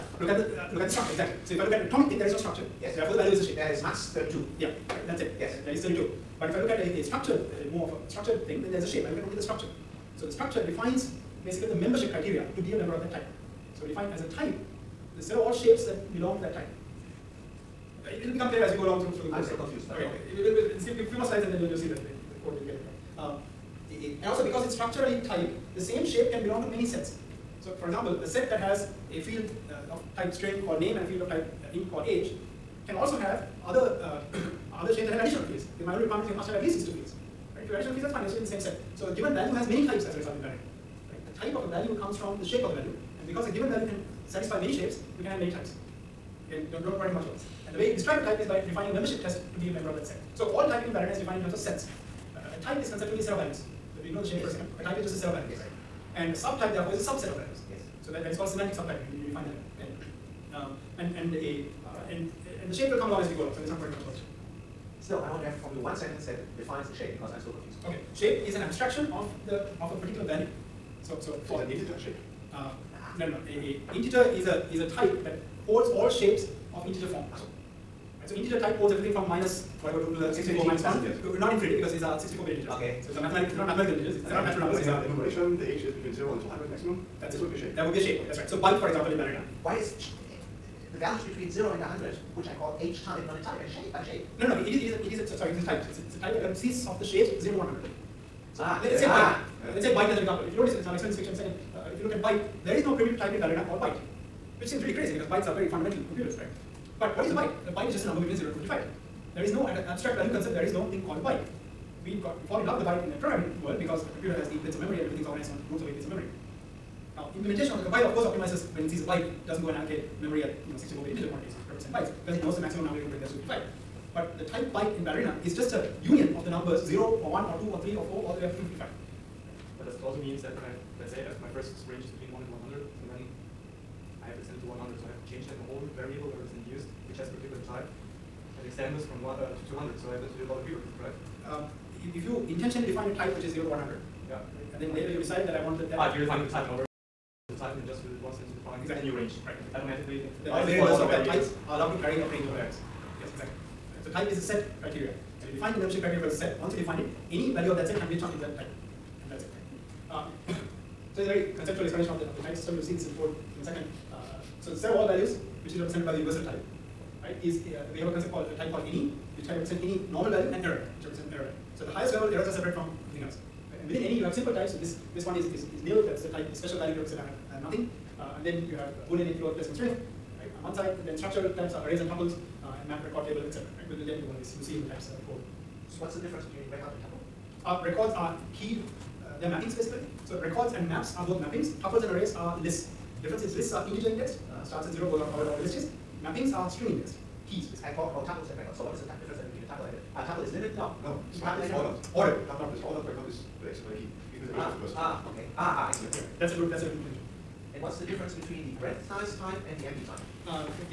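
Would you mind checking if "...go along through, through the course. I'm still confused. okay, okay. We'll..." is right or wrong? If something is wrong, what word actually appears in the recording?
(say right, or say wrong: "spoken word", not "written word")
right.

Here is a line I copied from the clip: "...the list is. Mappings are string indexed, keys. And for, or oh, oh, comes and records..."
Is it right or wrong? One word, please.
wrong.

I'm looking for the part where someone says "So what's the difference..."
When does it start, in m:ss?
3:05.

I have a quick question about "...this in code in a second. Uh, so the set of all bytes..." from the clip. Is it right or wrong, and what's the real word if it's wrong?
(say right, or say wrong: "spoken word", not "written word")
wrong: "values", not "bytes".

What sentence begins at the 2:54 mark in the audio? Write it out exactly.
This this one is, is, is nil, that's the type, the special value group said I have, I have nothing.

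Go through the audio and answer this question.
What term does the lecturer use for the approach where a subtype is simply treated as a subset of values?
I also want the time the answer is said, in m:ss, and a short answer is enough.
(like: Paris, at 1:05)
semantic subtyping, at 0:58.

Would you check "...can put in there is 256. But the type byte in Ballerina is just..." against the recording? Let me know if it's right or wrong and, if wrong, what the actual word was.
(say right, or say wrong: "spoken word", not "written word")
wrong: "255", not "256".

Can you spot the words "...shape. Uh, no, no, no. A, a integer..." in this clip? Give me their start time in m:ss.
1:11.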